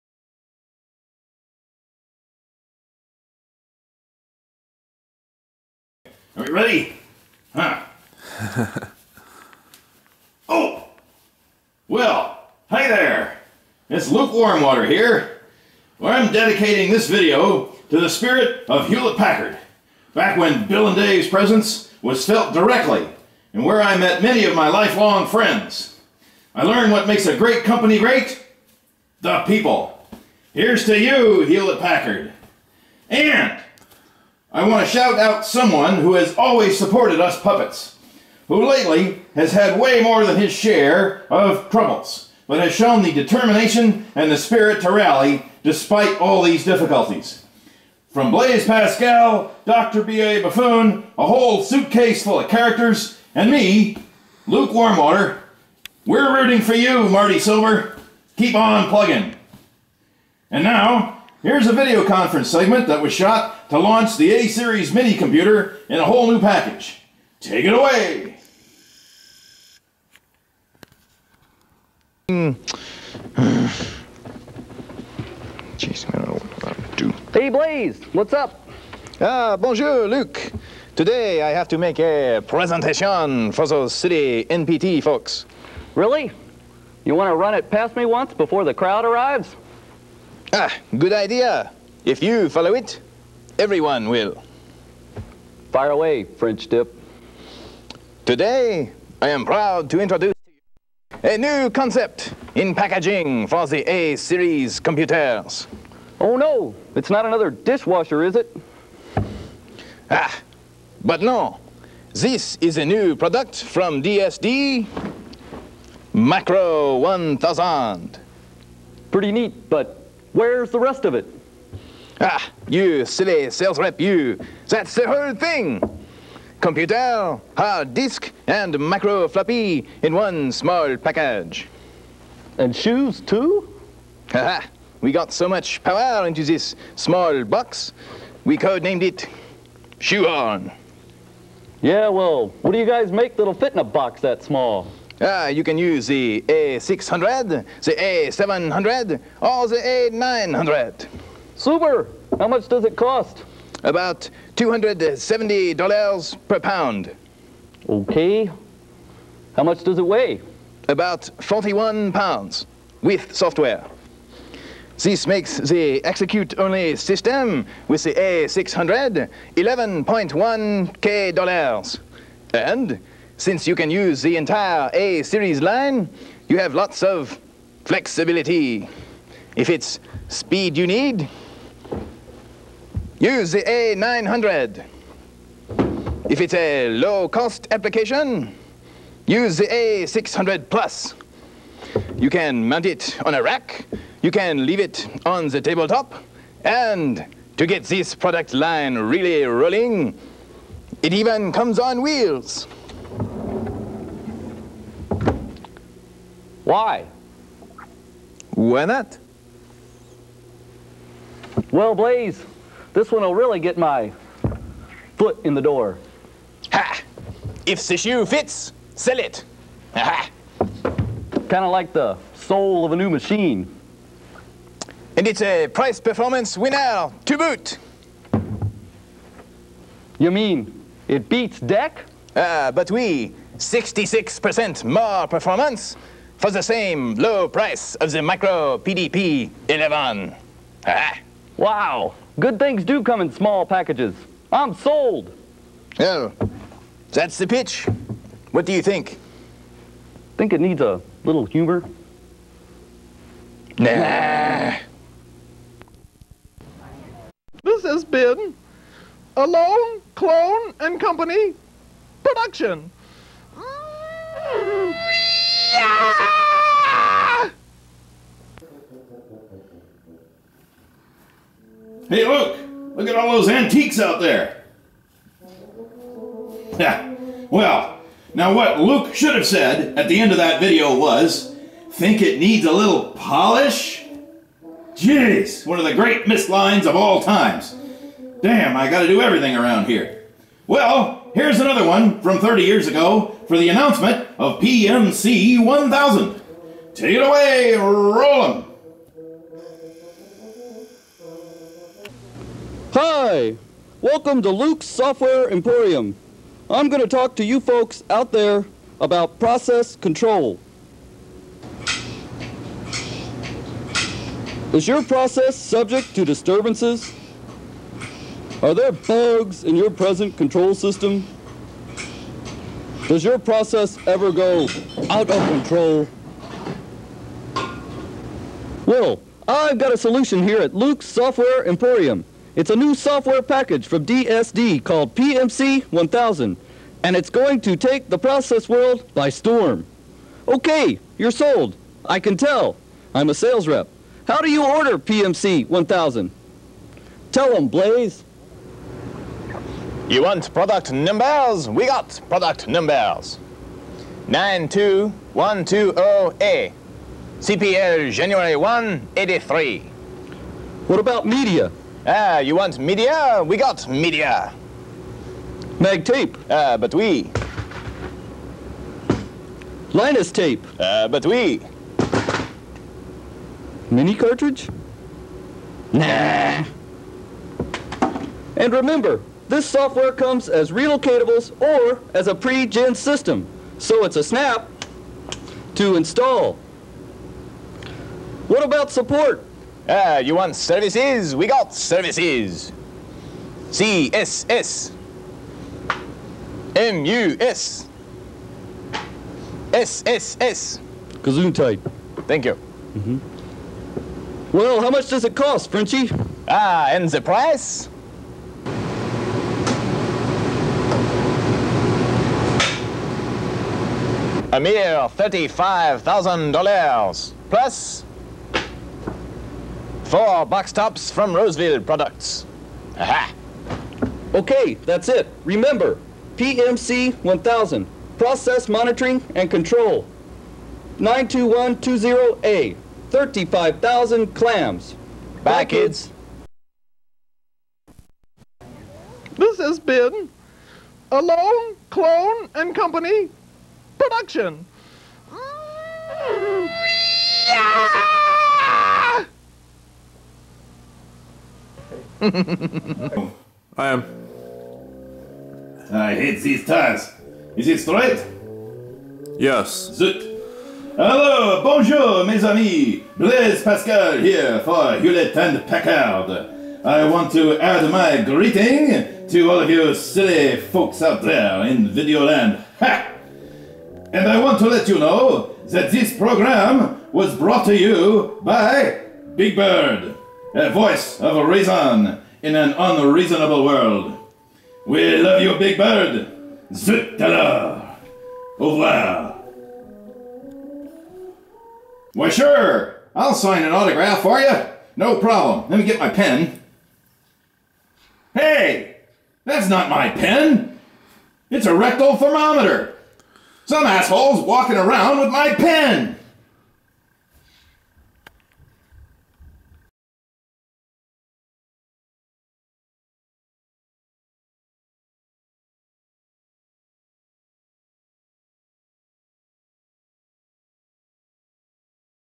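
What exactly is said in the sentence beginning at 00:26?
I learned what makes a great company great the people.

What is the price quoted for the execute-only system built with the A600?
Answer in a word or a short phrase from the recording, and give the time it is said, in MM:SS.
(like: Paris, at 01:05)
$11,100, at 02:49.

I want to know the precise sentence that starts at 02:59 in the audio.
If it's speed you need, Use the A900.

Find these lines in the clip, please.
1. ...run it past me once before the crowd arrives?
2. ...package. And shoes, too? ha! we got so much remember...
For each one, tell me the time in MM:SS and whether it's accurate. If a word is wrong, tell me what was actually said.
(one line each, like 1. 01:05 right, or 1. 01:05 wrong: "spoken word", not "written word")
1. 01:27 right
2. 02:10 wrong: "power", not "remember".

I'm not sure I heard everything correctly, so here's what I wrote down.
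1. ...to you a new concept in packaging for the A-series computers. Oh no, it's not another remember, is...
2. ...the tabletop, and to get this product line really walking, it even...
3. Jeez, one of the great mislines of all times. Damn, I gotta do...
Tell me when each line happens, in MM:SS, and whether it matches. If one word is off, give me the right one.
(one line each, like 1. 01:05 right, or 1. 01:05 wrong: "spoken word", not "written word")
1. 01:40 wrong: "dishwasher", not "remember"
2. 03:15 wrong: "rolling", not "walking"
3. 04:44 right.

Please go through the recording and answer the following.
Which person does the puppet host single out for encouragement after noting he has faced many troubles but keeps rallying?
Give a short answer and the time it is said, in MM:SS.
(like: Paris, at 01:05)
Marty Silver, at 00:57.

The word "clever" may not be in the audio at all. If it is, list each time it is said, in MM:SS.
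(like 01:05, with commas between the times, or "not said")
not said.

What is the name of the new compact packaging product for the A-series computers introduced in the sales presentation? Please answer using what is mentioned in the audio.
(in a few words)
Macro 1000.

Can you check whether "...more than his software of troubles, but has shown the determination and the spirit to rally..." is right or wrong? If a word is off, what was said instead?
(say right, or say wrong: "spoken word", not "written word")
wrong: "share", not "software".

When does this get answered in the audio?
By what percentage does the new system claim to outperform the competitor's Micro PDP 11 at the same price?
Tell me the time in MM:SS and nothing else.
03:53.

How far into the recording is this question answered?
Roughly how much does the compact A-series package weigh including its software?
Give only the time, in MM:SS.
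02:41.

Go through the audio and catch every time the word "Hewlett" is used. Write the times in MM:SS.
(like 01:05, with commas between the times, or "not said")
00:18, 00:31, 07:44.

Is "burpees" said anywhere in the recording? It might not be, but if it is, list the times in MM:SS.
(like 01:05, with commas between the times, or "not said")
not said.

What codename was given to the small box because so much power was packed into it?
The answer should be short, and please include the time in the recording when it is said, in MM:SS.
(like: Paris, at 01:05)
Shoe On, at 02:19.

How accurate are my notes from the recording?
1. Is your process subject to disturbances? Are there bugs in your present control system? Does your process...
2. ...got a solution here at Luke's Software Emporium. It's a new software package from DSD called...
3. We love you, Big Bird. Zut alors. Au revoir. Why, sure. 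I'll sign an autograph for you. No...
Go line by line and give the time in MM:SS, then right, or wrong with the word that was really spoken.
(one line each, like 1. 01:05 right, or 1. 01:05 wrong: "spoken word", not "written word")
1. 05:14 right
2. 05:29 right
3. 08:04 right.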